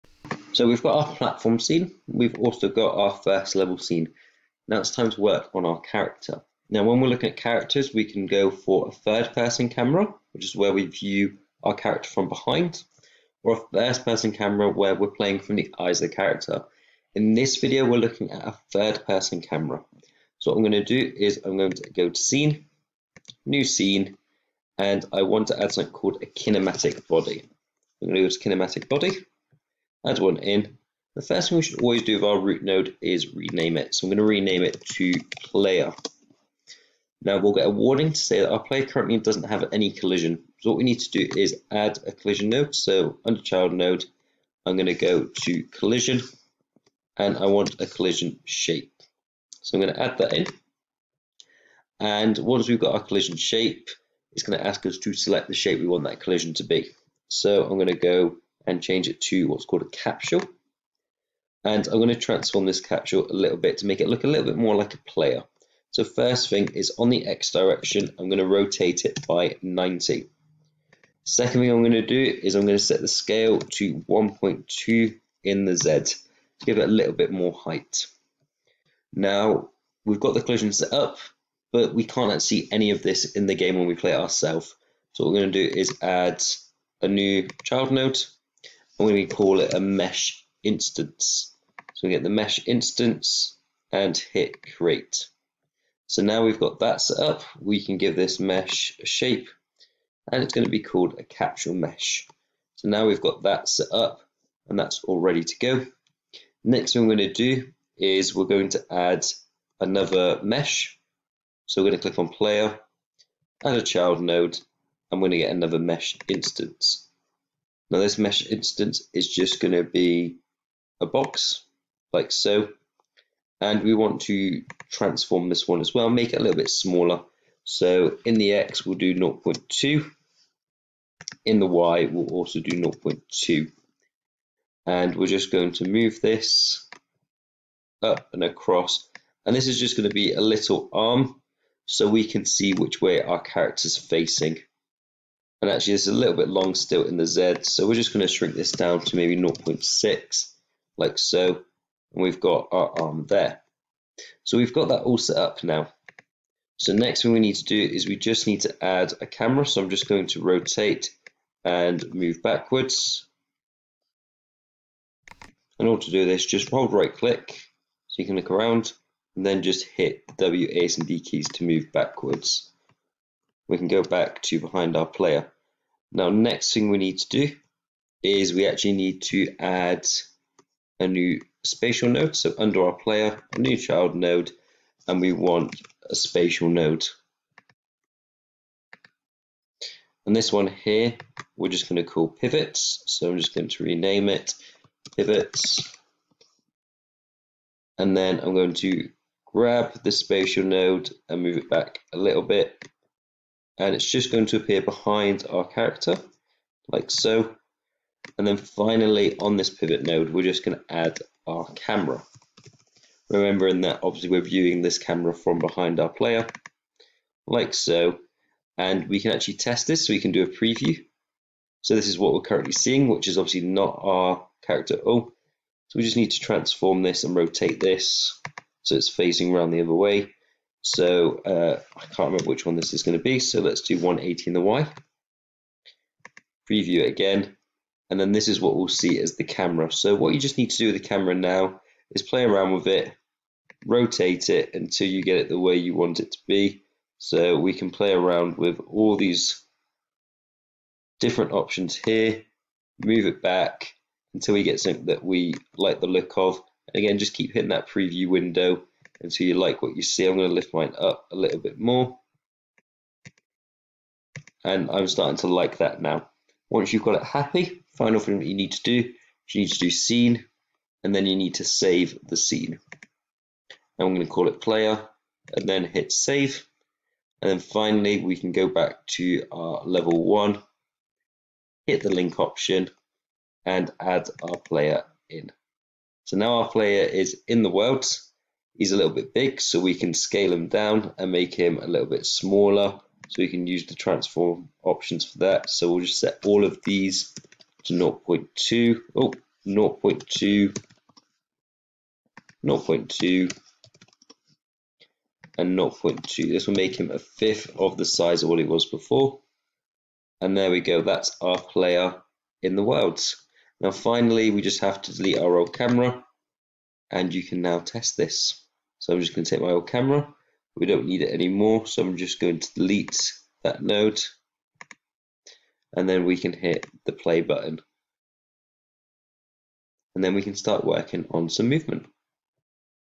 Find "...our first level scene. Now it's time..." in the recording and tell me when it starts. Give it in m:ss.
0:02.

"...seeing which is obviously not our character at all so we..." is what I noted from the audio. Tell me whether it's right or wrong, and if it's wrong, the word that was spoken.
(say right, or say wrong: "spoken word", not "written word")
right.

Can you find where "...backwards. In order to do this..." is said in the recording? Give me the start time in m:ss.
2:42.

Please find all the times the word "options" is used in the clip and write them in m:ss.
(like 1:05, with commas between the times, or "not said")
4:11, 4:42, 4:54.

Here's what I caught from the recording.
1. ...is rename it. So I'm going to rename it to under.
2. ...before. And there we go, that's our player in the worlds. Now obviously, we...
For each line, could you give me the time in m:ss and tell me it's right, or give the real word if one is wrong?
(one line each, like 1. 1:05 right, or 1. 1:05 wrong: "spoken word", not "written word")
1. 0:33 wrong: "player", not "under"
2. 5:08 wrong: "finally", not "obviously".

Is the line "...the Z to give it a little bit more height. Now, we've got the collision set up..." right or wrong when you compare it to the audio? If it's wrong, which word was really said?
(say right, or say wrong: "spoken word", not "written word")
right.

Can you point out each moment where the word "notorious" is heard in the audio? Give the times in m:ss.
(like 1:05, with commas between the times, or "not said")
not said.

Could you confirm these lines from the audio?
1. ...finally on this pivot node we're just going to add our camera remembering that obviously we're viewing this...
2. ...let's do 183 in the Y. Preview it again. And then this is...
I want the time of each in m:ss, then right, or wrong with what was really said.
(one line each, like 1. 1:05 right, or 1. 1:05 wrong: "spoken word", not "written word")
1. 3:28 right
2. 3:53 wrong: "180", not "183".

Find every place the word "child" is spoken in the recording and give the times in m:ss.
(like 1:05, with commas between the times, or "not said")
0:43, 1:27, 1:53, 3:03.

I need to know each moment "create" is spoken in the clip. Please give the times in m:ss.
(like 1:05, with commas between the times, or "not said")
1:34.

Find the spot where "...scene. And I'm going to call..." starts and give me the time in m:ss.
4:32.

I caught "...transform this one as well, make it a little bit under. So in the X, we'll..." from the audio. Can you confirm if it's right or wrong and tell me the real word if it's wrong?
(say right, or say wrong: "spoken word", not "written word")
wrong: "smaller", not "under".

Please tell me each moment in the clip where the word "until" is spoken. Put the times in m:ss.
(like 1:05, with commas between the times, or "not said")
4:04, 4:14, 4:19.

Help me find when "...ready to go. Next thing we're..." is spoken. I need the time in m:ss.
1:45.